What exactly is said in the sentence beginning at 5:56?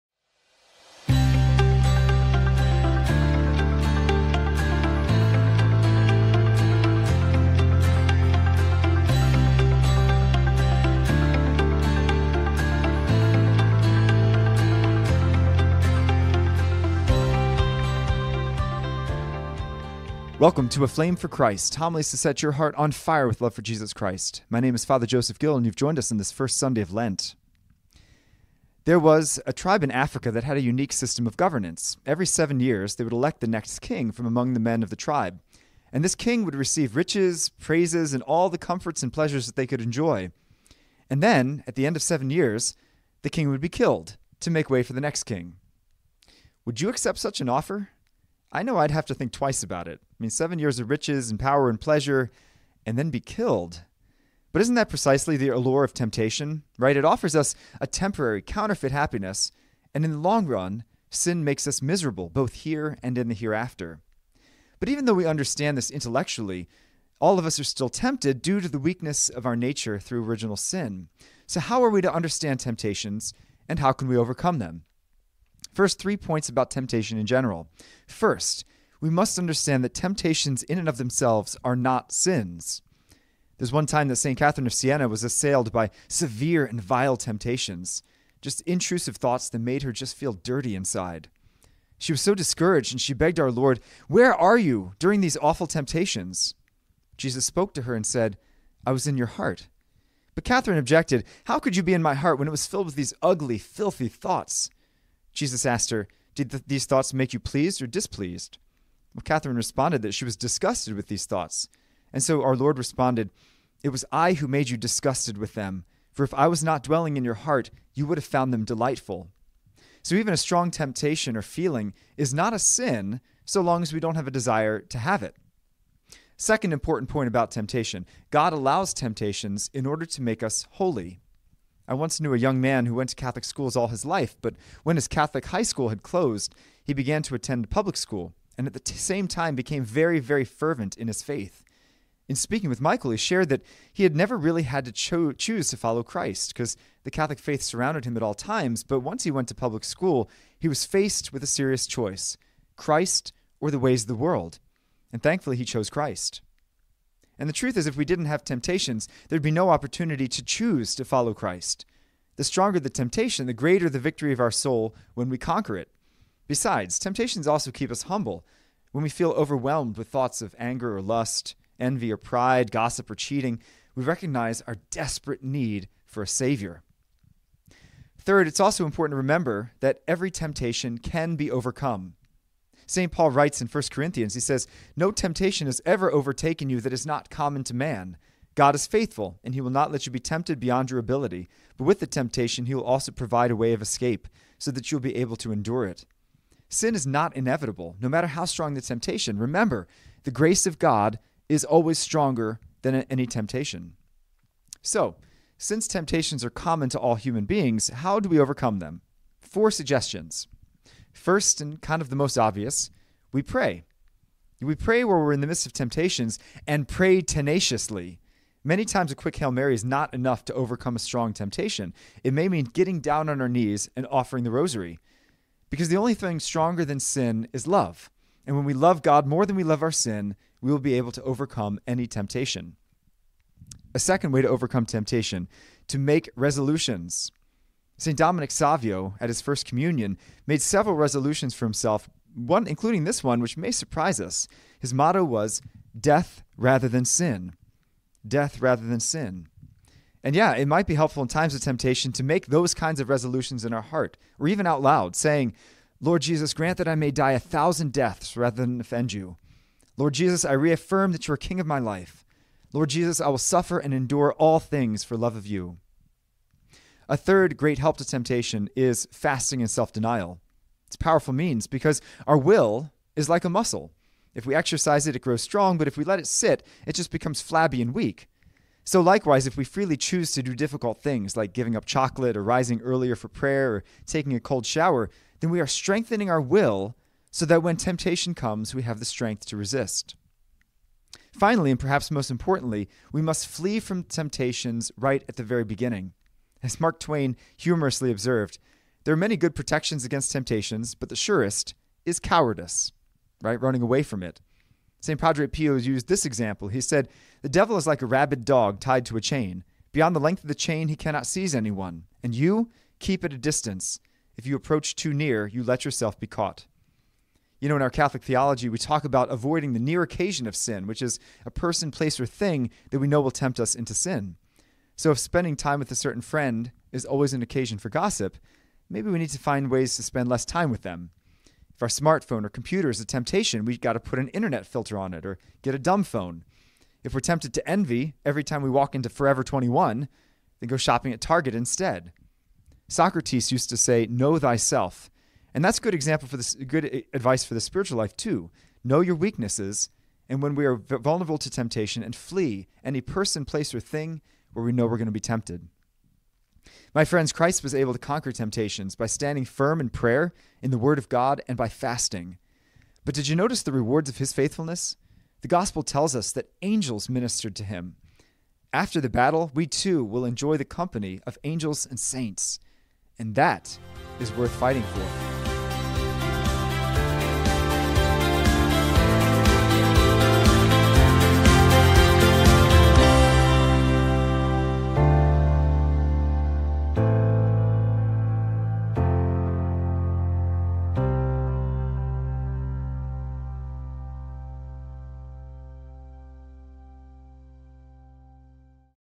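My friends, Christ was able to conquer temptations by standing firm in prayer, in the Word of God, and by fasting.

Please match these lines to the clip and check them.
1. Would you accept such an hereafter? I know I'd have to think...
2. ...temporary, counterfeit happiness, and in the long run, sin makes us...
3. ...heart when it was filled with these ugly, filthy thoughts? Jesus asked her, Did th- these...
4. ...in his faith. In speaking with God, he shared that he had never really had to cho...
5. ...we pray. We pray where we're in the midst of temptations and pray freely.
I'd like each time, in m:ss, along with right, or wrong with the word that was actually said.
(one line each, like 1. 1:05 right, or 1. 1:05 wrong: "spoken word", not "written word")
1. 0:46 wrong: "offer", not "hereafter"
2. 0:57 right
3. 1:42 right
4. 2:20 wrong: "Michael", not "God"
5. 3:33 wrong: "tenaciously", not "freely".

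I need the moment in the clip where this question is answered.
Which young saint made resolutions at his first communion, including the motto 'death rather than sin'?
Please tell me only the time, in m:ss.
3:58.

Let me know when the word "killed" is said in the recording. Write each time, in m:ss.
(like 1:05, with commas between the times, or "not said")
0:43, 0:53.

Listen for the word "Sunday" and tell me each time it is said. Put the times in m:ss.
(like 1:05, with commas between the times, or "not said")
0:26.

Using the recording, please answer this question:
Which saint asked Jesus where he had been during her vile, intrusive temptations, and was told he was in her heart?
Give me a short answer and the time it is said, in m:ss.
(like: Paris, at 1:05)
St. Catherine of Siena, at 1:24.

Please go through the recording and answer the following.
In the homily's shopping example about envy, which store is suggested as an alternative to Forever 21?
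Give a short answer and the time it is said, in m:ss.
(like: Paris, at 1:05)
Target, at 5:41.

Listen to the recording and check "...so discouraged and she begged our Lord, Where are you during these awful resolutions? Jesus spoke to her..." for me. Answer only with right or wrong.
wrong.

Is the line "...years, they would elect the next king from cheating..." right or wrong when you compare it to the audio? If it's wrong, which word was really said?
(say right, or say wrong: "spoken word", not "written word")
wrong: "among", not "cheating".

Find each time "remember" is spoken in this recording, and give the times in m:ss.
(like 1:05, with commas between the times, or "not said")
2:59, 3:19.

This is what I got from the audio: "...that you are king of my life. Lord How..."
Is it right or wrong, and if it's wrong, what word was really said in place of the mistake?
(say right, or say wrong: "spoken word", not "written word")
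wrong: "Jesus", not "How".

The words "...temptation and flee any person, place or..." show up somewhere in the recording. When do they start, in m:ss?
5:51.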